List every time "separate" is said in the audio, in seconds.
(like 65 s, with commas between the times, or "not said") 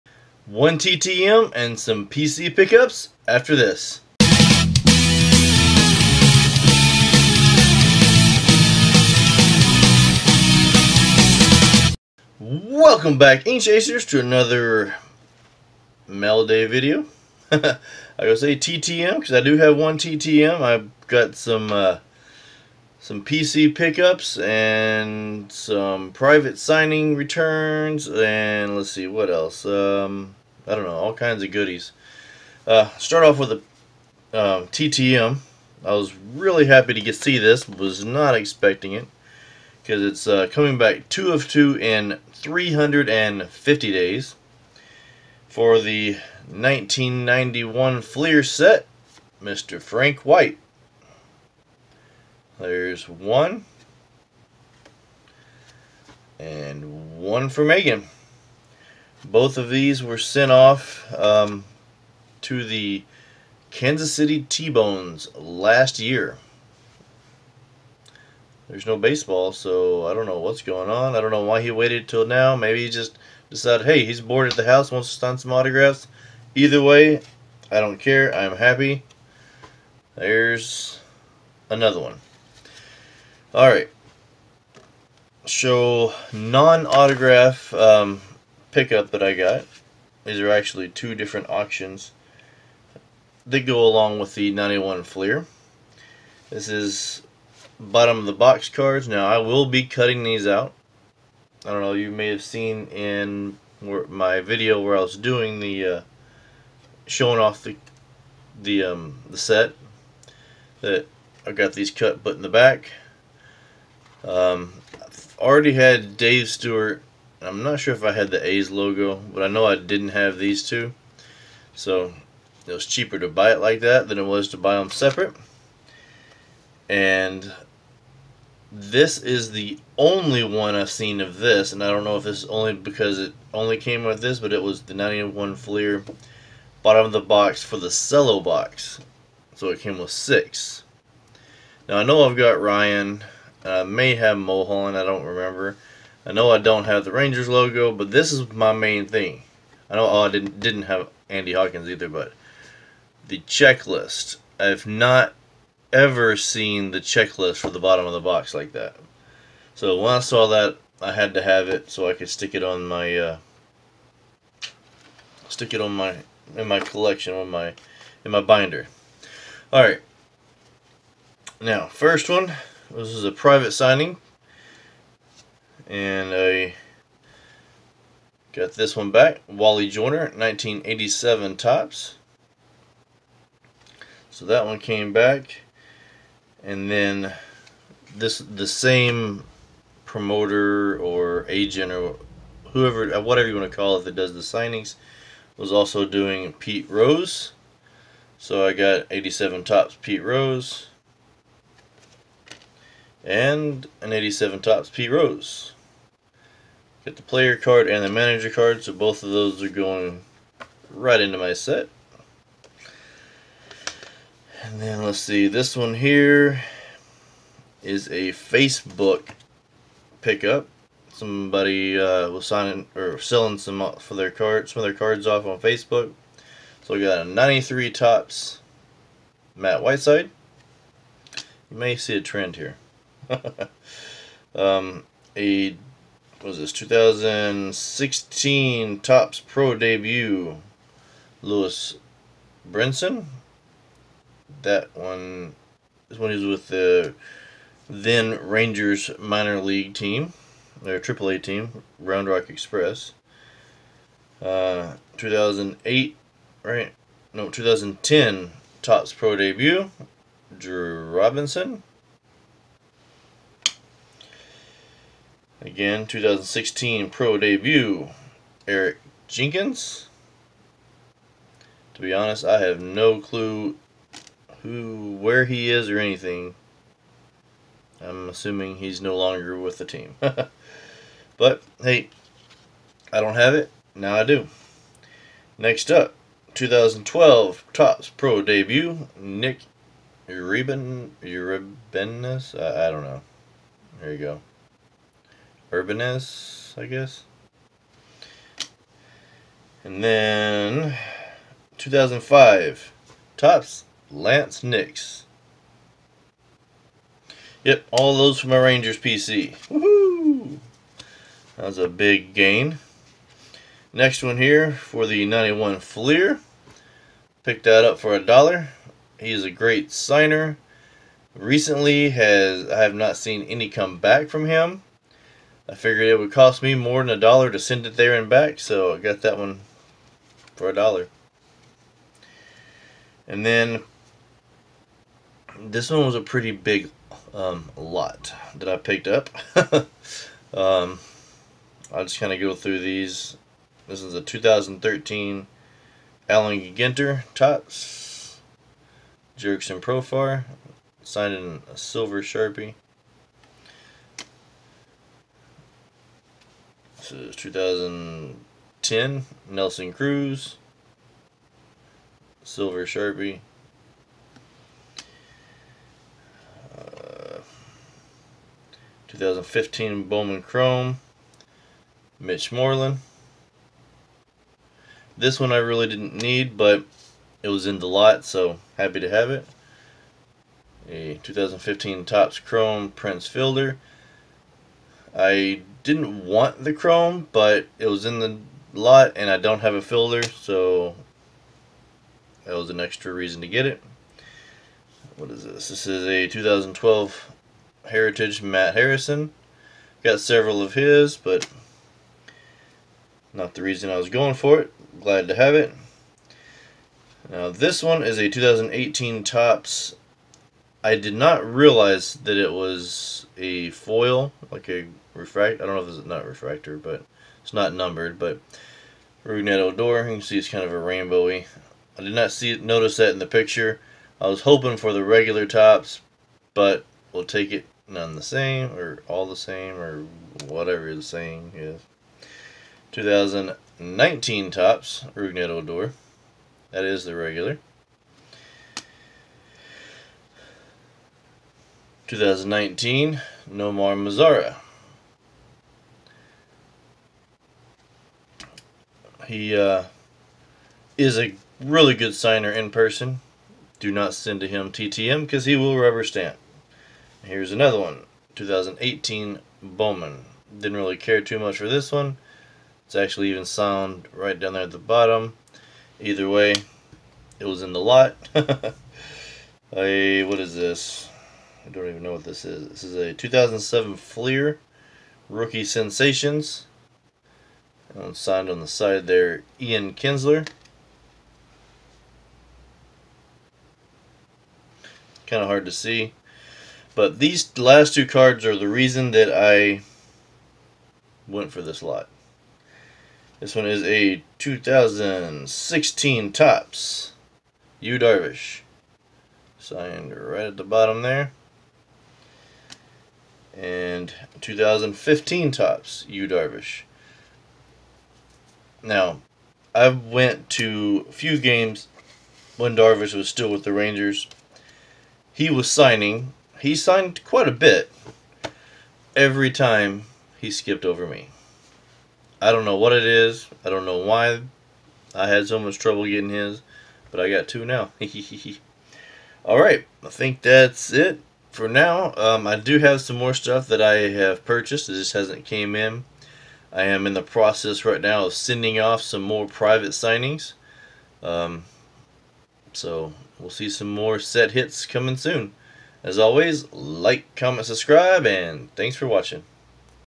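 124 s.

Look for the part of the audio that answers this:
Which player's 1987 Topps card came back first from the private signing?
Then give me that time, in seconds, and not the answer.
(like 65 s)
179 s.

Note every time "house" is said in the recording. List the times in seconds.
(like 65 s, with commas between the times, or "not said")
74 s.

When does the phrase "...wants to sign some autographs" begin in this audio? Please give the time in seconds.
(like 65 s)
74 s.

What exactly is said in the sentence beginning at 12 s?
Welcome back, Ink Chasers, to another Melody video.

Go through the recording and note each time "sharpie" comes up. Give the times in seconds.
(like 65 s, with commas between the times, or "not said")
352 s, 362 s.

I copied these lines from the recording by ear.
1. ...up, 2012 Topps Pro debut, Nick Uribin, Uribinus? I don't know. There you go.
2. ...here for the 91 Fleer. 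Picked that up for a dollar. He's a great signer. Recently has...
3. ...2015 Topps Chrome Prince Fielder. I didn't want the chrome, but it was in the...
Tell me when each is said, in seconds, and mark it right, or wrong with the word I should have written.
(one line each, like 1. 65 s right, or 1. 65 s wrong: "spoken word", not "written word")
1. 285 s right
2. 314 s right
3. 381 s right.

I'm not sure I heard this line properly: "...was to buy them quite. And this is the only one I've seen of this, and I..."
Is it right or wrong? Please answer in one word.
wrong.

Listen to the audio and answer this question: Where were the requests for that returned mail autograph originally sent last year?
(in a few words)
Kansas City T-Bones.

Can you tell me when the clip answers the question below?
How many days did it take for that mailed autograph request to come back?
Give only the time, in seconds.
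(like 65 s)
42 s.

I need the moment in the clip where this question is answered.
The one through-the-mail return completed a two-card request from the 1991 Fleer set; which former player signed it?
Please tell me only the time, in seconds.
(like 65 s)
49 s.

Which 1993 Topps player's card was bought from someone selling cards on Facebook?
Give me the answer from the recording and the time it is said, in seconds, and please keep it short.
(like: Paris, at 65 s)
Matt Whiteside, at 229 s.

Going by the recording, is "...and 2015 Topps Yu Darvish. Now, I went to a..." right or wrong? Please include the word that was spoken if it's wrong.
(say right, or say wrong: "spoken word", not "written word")
right.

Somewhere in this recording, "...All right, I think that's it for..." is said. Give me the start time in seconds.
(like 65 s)
529 s.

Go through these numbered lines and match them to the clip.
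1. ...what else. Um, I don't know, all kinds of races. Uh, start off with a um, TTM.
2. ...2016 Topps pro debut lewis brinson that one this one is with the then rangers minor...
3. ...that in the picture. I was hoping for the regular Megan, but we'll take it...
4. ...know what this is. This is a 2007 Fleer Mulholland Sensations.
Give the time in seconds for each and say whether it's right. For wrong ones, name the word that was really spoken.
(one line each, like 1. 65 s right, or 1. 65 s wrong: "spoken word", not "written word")
1. 29 s wrong: "goodies", not "races"
2. 236 s right
3. 422 s wrong: "Topps", not "Megan"
4. 472 s wrong: "Rookie", not "Mulholland".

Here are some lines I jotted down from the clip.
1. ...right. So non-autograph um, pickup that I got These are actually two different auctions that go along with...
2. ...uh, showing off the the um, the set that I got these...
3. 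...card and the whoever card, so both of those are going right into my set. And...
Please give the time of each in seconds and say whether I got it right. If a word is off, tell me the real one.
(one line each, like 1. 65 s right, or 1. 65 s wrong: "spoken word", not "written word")
1. 83 s right
2. 105 s right
3. 207 s wrong: "manager", not "whoever".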